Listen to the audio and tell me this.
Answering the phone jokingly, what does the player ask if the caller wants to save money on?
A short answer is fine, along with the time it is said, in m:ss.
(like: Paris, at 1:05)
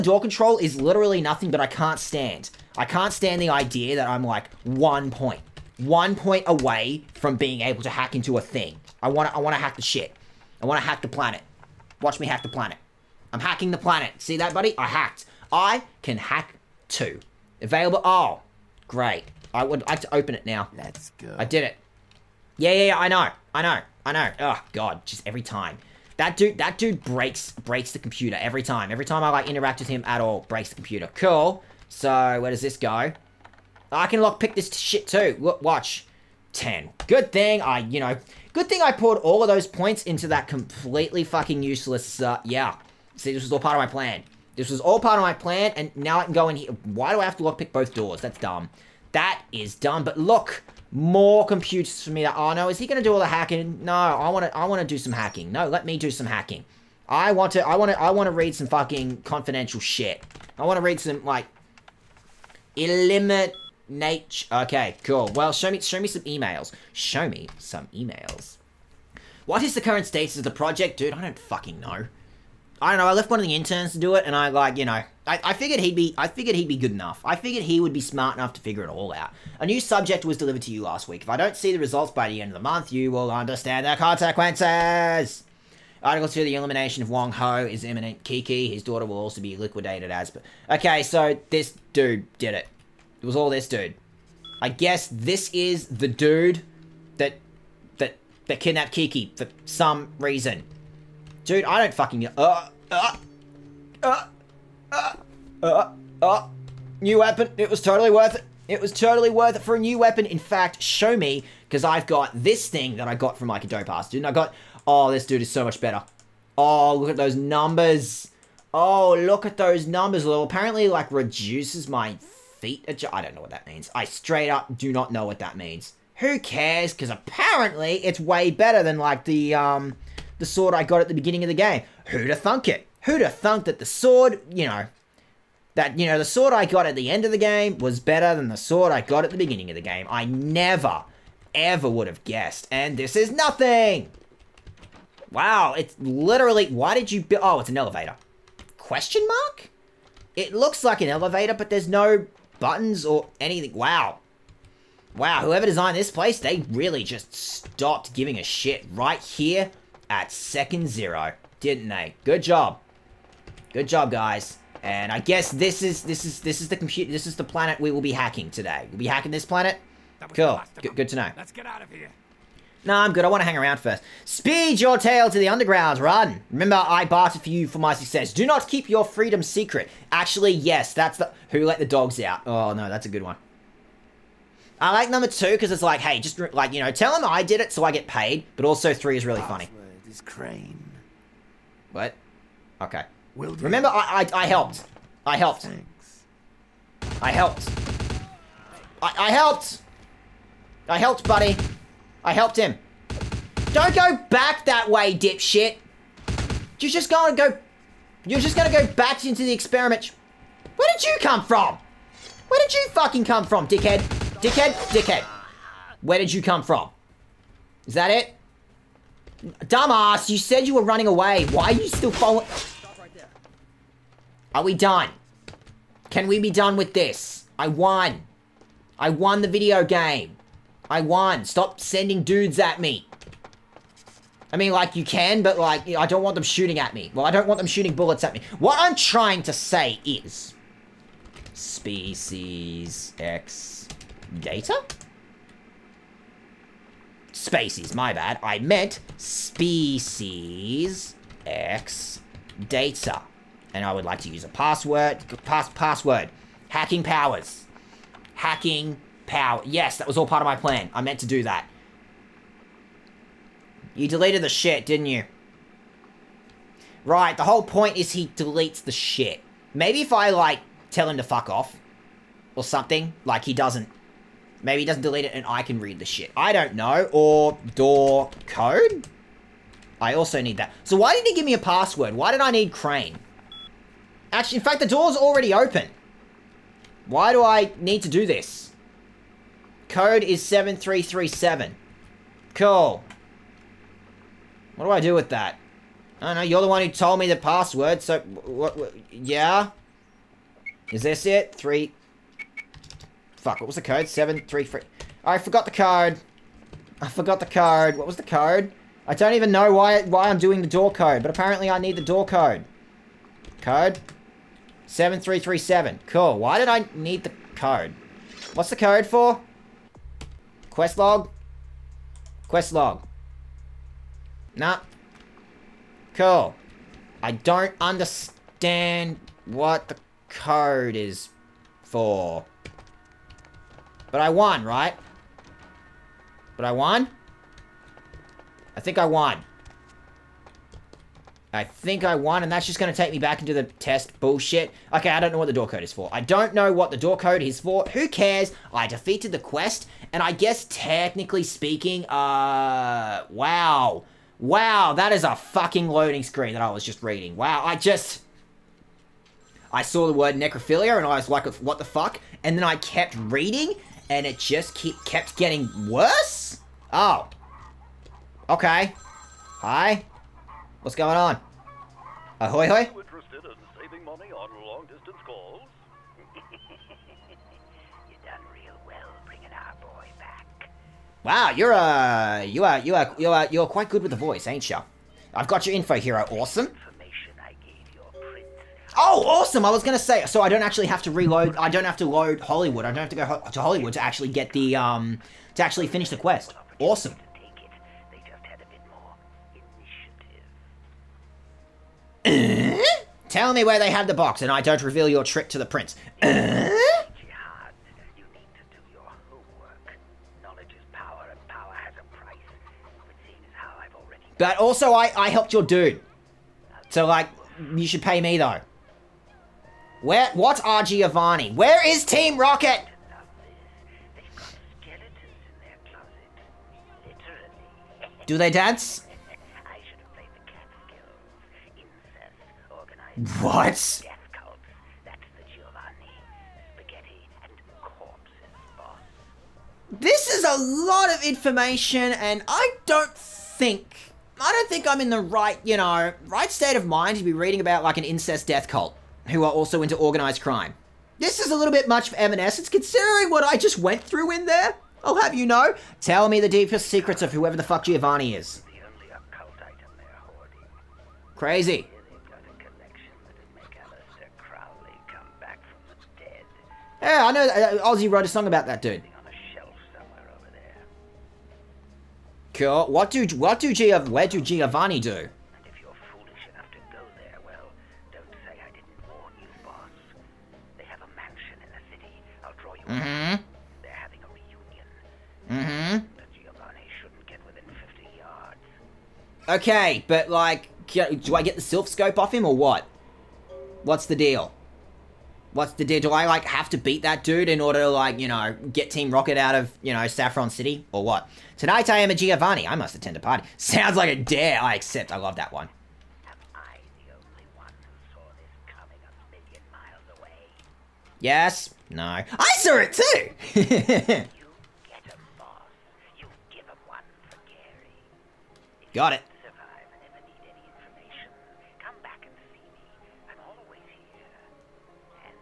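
long distance calls, at 6:14.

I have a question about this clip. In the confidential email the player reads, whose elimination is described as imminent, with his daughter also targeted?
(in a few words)
Wong Ho.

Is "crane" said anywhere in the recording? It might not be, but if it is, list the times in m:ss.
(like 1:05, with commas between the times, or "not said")
3:10, 4:42.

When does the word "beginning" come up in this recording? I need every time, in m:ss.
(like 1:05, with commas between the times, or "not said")
2:11, 2:19.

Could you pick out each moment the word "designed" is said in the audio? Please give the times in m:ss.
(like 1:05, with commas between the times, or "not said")
2:35.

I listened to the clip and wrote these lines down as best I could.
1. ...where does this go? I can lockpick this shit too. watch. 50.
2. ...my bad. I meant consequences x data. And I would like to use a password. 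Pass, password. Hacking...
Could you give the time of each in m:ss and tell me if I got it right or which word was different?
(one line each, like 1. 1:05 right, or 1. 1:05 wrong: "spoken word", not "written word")
1. 0:32 wrong: "10", not "50"
2. 4:07 wrong: "species", not "consequences".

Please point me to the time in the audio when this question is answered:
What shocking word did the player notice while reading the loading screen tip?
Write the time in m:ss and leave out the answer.
6:00.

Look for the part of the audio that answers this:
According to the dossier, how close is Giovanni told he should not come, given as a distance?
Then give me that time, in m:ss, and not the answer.
8:07.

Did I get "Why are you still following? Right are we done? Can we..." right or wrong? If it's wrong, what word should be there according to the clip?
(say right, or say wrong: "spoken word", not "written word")
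right.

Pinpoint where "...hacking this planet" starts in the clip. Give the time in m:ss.
2:49.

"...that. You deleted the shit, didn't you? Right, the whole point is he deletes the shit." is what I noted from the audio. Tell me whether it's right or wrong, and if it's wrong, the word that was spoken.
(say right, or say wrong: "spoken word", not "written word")
right.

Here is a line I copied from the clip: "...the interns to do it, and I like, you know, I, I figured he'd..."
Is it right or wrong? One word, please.
right.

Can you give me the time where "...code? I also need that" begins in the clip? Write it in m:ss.
4:38.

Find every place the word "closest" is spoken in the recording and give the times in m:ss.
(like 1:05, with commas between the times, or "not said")
not said.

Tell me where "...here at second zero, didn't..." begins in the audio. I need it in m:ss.
2:39.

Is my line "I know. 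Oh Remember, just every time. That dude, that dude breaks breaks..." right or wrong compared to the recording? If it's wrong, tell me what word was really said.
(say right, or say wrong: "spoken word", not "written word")
wrong: "God", not "Remember".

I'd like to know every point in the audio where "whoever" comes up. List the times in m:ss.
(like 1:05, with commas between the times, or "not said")
2:35, 7:37.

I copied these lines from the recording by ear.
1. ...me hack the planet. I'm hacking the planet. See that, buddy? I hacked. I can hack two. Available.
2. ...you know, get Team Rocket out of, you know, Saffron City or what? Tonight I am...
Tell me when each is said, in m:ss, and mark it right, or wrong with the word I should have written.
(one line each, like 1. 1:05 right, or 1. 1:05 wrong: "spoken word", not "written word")
1. 0:12 right
2. 8:18 right.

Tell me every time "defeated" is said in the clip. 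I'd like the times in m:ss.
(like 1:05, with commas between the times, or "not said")
5:48.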